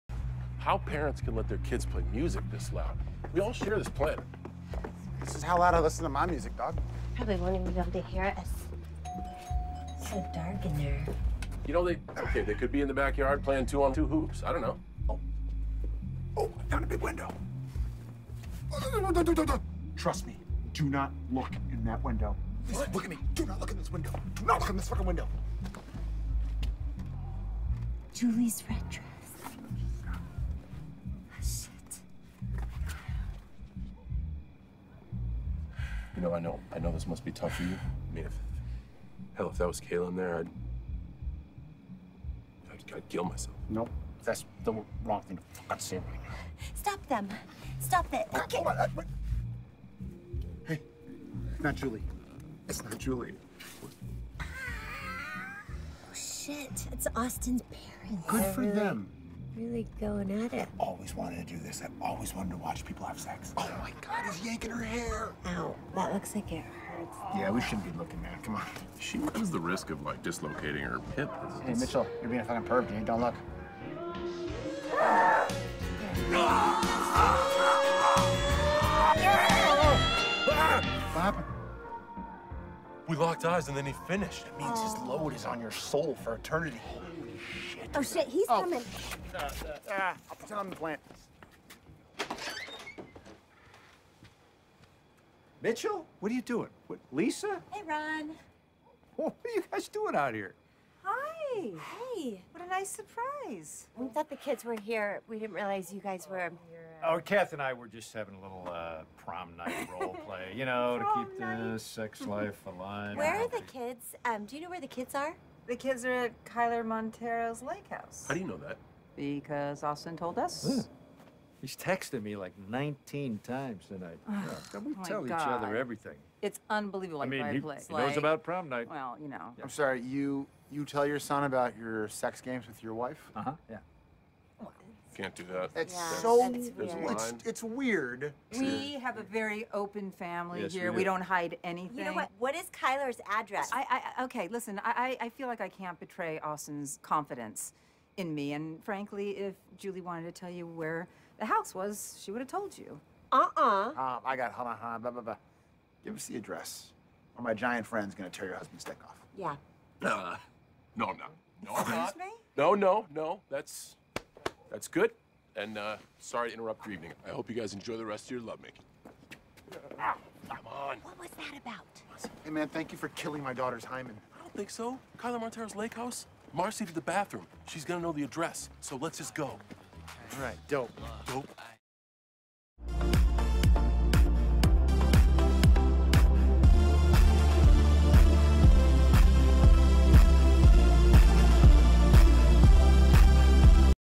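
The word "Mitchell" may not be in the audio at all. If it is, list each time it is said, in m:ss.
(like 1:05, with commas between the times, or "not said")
1:11, 1:35.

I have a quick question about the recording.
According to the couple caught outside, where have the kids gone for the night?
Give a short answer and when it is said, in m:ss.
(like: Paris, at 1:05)
Kyler Montero's lake house, at 1:56.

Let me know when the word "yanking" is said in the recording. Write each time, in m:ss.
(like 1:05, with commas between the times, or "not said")
1:04.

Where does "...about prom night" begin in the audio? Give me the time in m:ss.
2:08.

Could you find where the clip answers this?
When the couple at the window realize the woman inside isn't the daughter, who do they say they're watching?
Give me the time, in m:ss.
0:57.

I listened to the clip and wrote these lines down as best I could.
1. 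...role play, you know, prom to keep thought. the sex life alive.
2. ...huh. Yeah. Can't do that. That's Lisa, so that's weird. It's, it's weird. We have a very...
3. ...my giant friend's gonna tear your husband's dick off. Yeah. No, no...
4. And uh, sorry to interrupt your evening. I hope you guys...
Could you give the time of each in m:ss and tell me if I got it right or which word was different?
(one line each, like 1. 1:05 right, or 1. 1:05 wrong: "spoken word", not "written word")
1. 1:49 wrong: "night", not "thought"
2. 2:13 wrong: "Yeah", not "Lisa"
3. 2:37 right
4. 2:45 right.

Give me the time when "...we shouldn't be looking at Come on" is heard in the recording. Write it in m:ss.
1:07.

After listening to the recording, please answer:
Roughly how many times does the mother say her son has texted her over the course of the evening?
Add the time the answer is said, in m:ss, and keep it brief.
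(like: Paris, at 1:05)
19, at 2:02.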